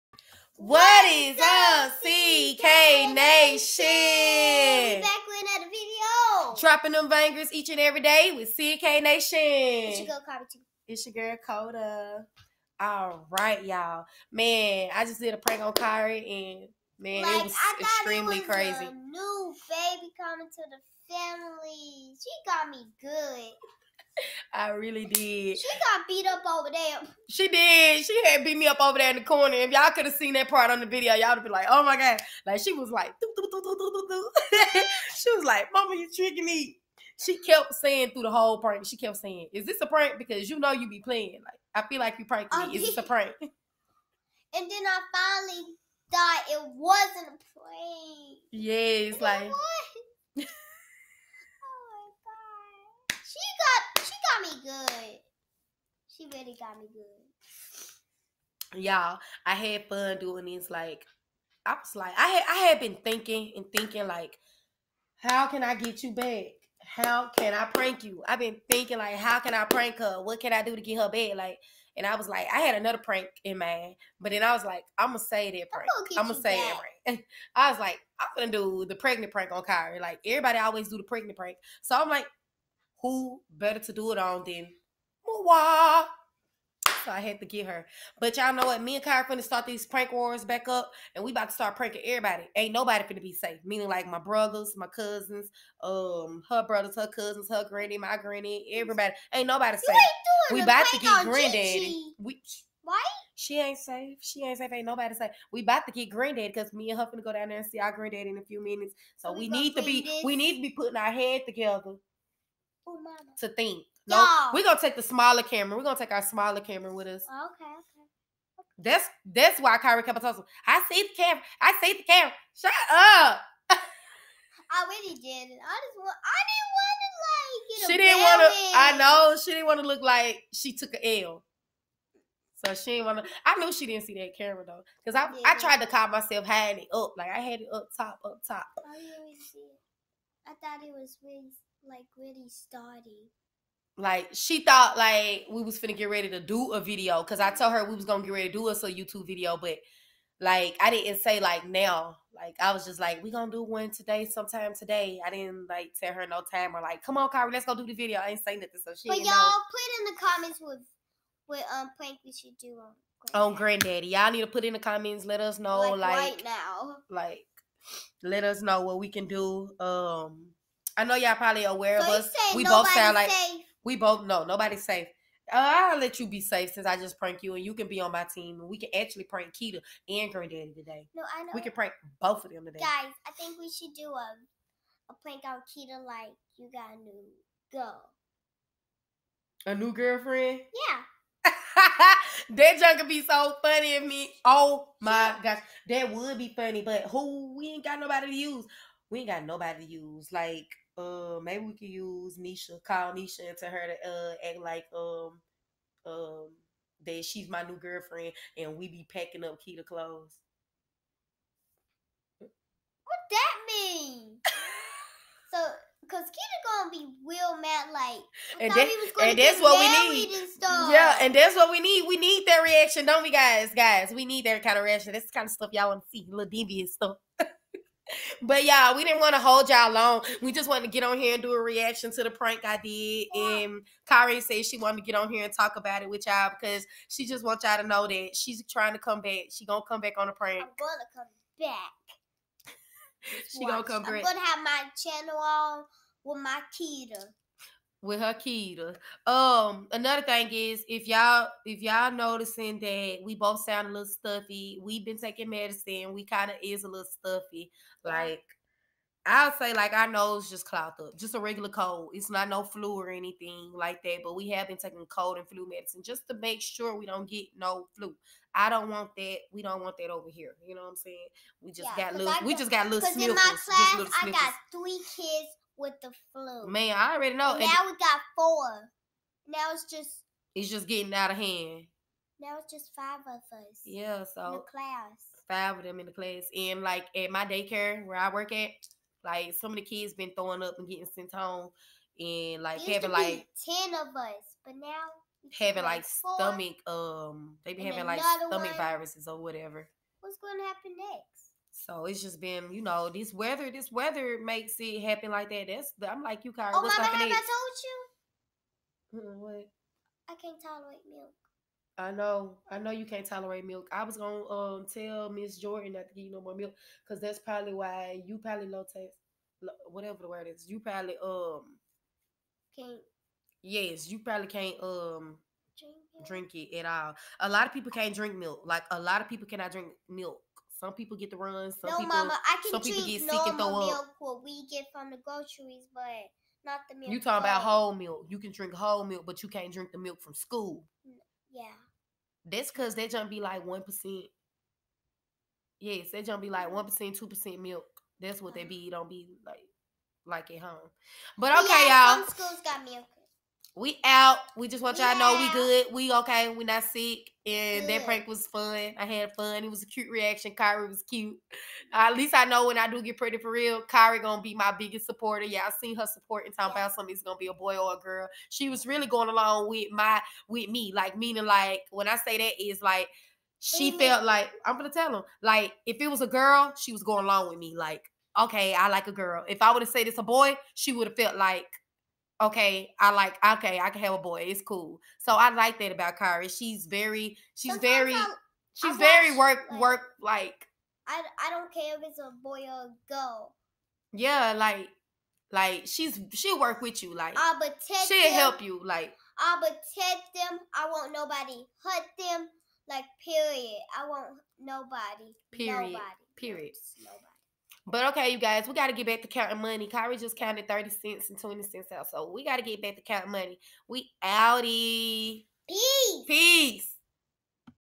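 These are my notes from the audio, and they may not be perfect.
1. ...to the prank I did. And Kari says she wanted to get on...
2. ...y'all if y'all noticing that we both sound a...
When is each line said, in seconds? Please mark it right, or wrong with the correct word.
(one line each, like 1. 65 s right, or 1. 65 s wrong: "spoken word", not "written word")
1. 232 s right
2. 251 s right.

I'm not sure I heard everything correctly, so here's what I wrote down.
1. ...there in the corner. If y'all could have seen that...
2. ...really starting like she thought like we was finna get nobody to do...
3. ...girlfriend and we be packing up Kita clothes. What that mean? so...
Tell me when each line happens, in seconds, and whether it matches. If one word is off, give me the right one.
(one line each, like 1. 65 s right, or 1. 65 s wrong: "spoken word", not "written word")
1. 28 s right
2. 142 s wrong: "ready", not "nobody"
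3. 207 s right.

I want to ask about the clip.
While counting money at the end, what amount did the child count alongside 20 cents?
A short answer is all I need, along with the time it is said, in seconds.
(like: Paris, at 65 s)
30 cents, at 410 s.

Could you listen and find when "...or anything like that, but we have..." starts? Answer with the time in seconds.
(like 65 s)
262 s.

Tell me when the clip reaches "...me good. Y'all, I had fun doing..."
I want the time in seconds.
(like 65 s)
56 s.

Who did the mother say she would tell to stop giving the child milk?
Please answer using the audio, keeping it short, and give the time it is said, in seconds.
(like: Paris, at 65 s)
Miss Jordan, at 315 s.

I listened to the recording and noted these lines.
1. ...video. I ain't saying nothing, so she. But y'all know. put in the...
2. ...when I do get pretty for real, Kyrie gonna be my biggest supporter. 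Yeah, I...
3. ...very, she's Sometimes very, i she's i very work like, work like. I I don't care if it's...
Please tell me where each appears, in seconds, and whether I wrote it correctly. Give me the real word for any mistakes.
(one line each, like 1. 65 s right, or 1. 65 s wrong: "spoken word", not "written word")
1. 157 s right
2. 362 s right
3. 386 s right.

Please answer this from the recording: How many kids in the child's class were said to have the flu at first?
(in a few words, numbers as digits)
3.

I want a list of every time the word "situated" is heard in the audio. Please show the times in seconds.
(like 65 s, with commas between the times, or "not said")
not said.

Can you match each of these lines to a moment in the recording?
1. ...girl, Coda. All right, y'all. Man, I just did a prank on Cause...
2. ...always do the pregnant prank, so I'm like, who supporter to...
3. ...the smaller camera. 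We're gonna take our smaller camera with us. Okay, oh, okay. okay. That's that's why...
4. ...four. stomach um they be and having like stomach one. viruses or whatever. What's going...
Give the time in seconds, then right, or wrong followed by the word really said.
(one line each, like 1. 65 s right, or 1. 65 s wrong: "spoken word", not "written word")
1. 11 s wrong: "Kyrie", not "Cause"
2. 80 s wrong: "better", not "supporter"
3. 114 s right
4. 296 s right.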